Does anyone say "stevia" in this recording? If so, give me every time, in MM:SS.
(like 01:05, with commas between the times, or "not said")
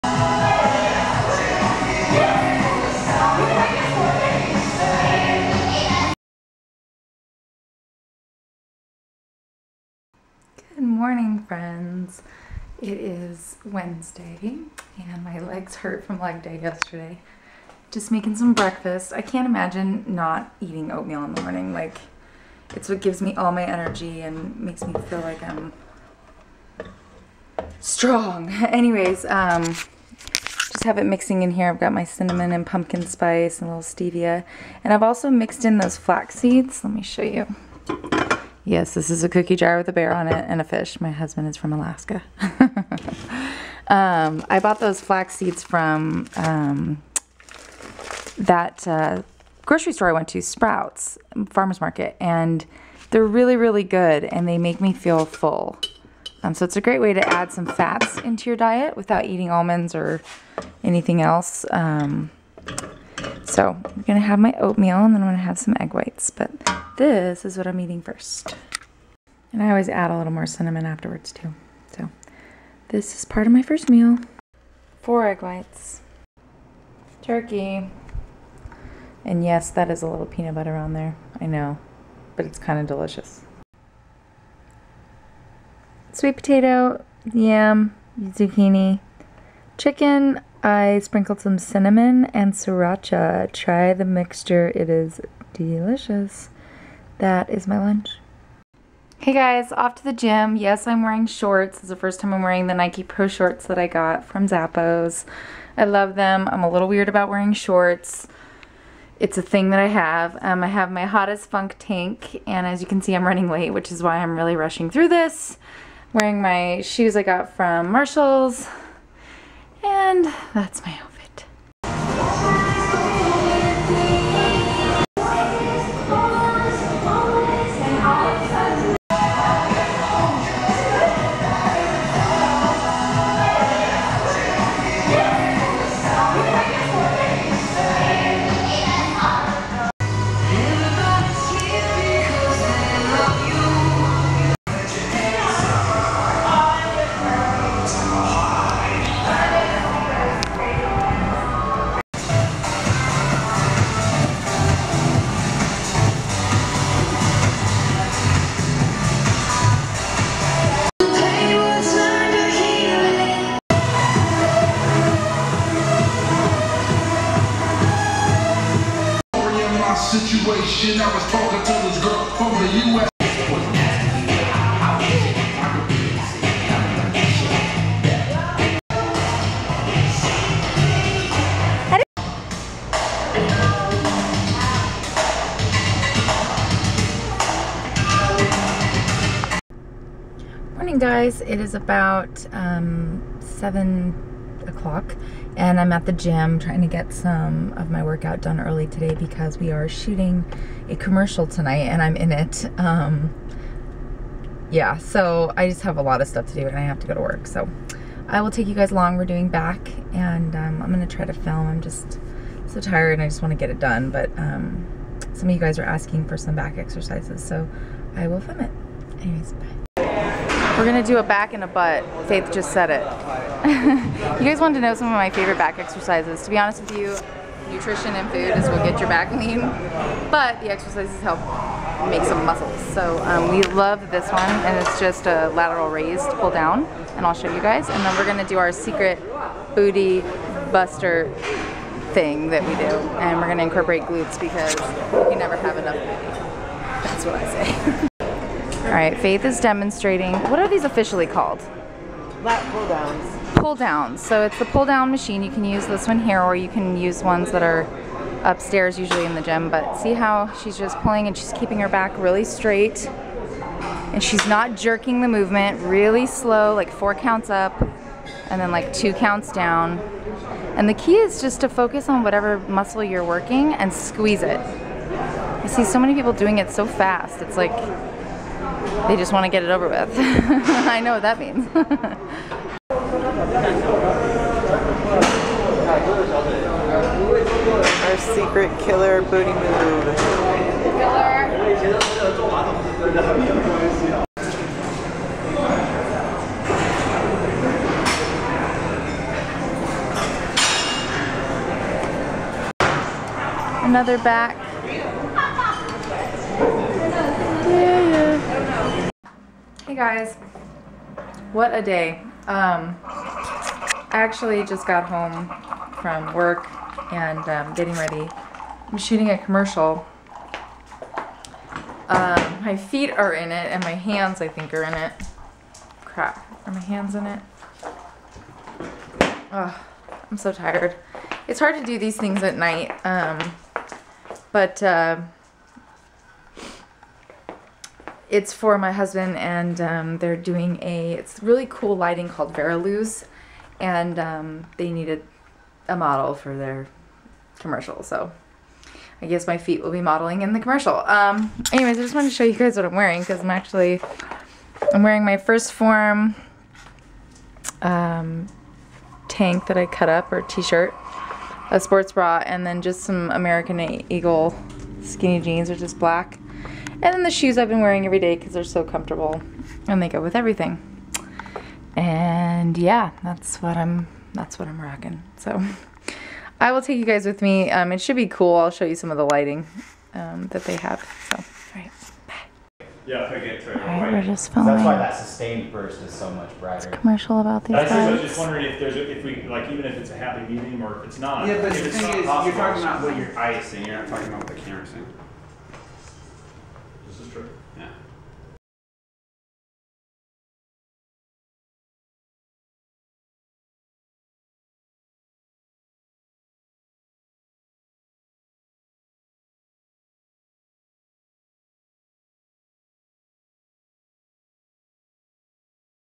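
00:33.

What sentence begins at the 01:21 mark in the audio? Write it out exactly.
I know, but it's kind of delicious.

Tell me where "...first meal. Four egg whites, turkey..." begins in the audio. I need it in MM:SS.
01:13.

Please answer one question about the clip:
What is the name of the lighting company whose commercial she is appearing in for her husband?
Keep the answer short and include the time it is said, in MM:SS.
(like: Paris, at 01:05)
Veriluz, at 05:42.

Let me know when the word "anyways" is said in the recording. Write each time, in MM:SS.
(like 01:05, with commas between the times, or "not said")
00:28, 03:39, 05:51.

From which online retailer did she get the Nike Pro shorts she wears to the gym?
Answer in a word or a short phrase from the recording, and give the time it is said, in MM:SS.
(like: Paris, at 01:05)
Zappos, at 01:44.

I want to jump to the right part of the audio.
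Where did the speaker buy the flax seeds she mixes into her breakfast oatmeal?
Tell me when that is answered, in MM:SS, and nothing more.
00:50.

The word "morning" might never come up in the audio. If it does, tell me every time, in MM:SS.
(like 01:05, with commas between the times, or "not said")
00:11, 00:21, 03:10.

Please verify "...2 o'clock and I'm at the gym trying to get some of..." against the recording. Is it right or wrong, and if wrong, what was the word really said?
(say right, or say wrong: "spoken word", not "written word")
wrong: "7", not "2".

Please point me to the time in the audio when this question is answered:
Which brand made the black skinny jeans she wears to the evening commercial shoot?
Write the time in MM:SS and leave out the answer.
06:03.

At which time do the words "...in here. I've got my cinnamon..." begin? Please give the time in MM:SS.
00:31.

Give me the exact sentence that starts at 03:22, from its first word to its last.
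Um, yeah, so I just have a lot of stuff to do and I have to go to work.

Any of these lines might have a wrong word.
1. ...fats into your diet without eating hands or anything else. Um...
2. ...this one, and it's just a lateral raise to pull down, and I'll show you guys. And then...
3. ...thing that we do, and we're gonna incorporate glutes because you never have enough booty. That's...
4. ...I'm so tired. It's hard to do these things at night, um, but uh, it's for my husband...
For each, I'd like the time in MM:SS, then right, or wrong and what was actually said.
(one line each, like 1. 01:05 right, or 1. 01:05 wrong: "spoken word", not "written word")
1. 00:57 wrong: "almonds", not "hands"
2. 03:54 right
3. 04:02 right
4. 05:30 right.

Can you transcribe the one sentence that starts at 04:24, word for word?
And she's not jerking the movement, really slow, like four counts up, and then like two counts down.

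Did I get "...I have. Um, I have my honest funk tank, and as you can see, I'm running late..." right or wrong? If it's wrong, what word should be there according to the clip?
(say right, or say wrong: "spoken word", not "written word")
wrong: "hottest", not "honest".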